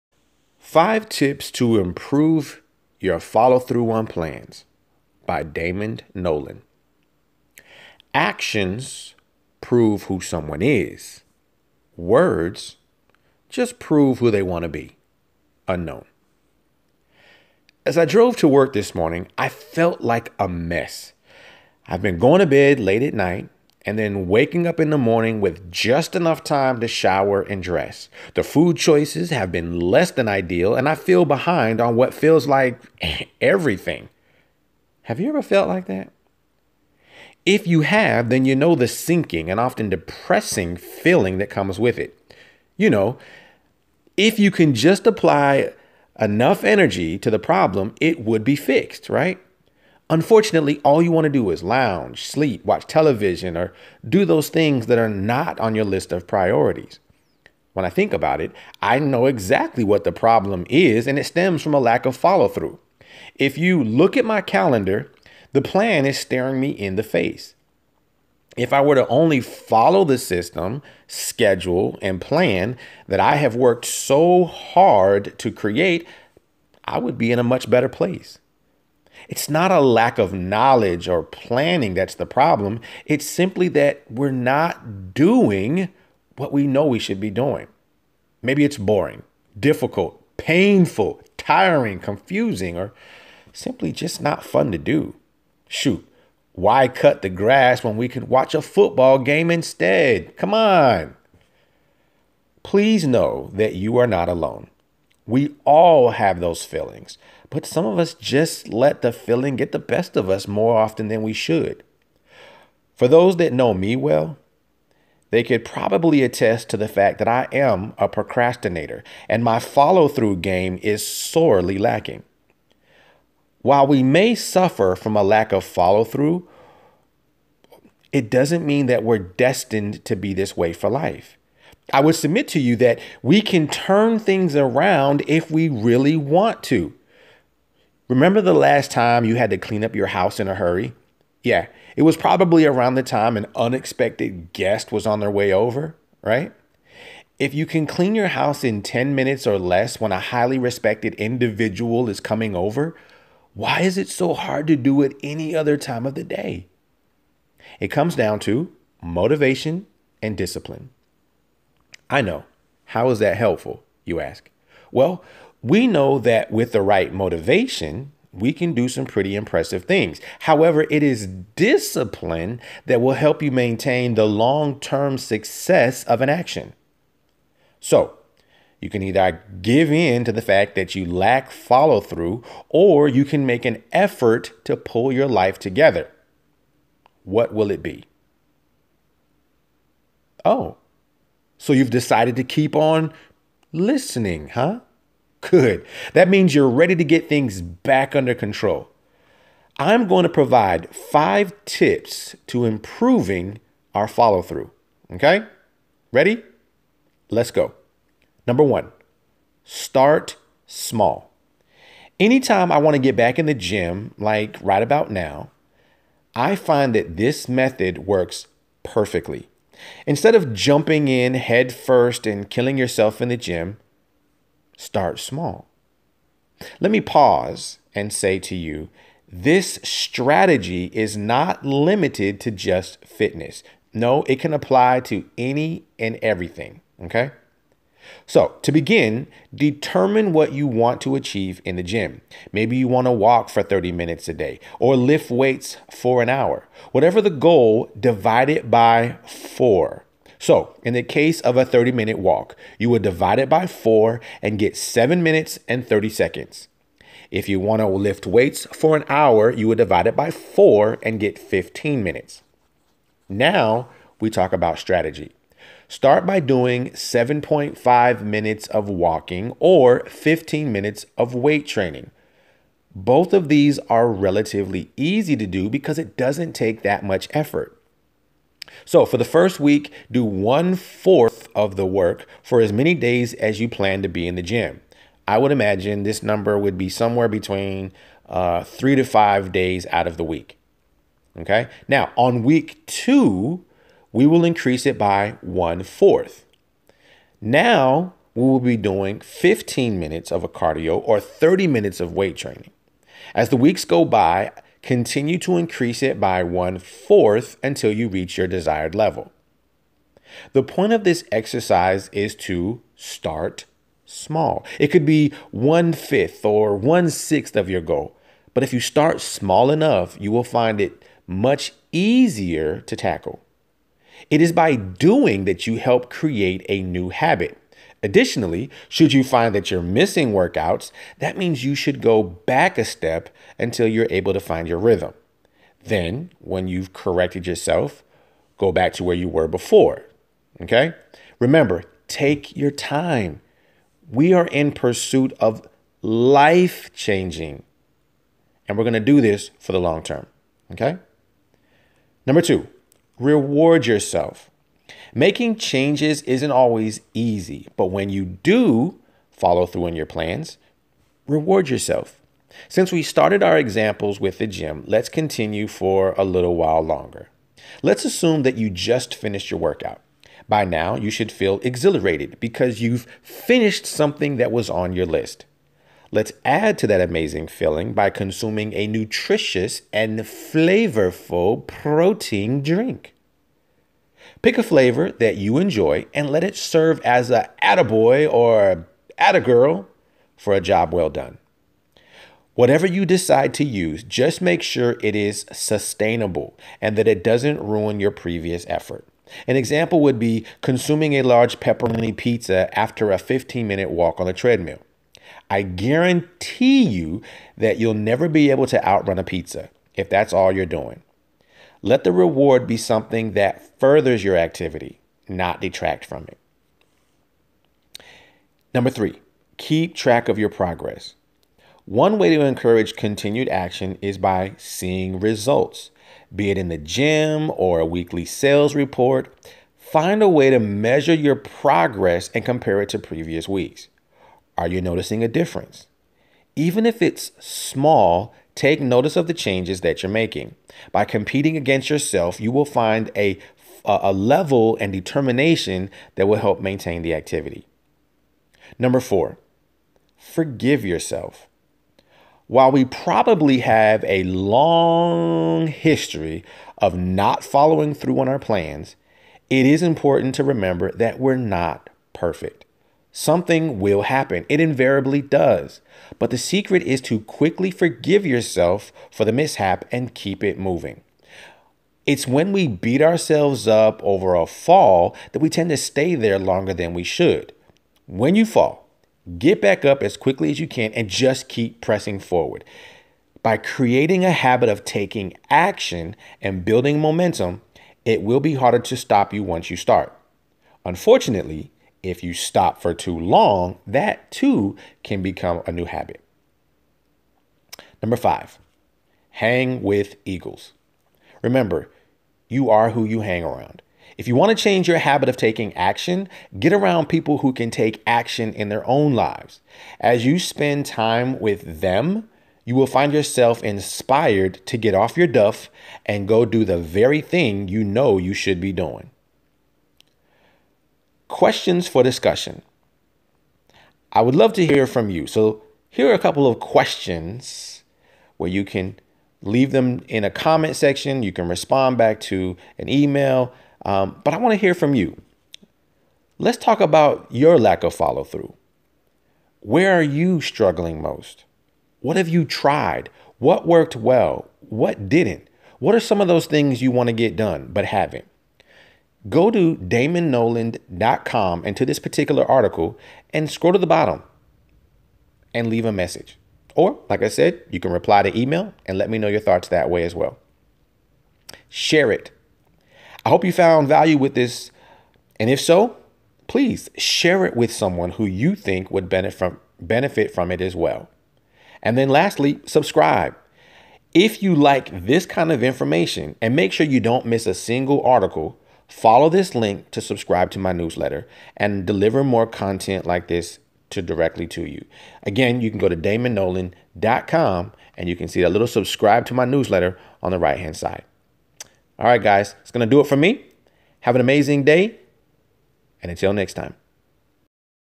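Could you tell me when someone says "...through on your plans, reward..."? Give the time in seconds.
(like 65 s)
359 s.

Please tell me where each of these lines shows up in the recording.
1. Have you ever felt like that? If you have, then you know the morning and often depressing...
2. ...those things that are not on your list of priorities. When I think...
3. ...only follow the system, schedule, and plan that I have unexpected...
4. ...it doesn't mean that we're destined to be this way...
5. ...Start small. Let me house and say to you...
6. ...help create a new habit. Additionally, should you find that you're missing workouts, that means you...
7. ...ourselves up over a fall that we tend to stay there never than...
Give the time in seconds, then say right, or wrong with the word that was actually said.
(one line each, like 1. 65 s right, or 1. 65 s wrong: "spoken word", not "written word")
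1. 35 s wrong: "sinking", not "morning"
2. 54 s right
3. 69 s wrong: "worked", not "unexpected"
4. 128 s right
5. 224 s wrong: "pause", not "house"
6. 325 s right
7. 473 s wrong: "longer", not "never".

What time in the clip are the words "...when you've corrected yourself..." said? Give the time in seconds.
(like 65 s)
336 s.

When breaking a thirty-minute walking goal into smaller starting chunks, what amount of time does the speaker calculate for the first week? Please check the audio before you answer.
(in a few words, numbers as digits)
7 minutes 30 seconds.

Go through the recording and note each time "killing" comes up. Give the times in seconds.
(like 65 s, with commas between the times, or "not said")
222 s.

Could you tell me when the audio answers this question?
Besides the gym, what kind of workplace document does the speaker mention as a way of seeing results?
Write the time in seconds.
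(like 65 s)
427 s.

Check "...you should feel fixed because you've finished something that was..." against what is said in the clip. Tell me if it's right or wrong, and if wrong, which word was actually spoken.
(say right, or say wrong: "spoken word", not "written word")
wrong: "exhilarated", not "fixed".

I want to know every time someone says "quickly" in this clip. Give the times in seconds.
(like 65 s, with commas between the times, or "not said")
467 s, 480 s.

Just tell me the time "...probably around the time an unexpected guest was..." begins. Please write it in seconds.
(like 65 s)
142 s.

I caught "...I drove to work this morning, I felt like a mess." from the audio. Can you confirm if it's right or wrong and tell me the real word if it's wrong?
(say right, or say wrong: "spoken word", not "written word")
right.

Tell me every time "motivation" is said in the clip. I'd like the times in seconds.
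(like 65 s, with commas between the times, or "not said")
159 s, 167 s.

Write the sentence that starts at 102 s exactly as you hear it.
Please know that you are not alone.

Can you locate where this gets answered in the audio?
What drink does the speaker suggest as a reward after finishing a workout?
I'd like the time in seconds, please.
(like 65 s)
381 s.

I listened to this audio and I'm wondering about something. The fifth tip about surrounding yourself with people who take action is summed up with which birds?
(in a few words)
eagles.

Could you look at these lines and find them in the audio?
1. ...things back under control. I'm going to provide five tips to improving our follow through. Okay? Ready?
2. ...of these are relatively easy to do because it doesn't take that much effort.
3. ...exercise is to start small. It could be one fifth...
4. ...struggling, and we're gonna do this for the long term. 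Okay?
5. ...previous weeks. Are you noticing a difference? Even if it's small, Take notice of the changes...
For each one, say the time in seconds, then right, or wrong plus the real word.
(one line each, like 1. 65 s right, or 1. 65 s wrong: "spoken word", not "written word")
1. 197 s right
2. 273 s right
3. 311 s right
4. 346 s wrong: "changing", not "struggling"
5. 432 s right.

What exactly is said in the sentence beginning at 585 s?
Again, you can go to damondnollan.com and you can see that little subscribe to my newsletter on the right hand side.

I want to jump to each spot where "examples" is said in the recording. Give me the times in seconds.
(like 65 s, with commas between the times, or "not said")
363 s, 399 s.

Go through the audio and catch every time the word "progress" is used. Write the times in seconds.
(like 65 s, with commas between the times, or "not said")
420 s, 431 s.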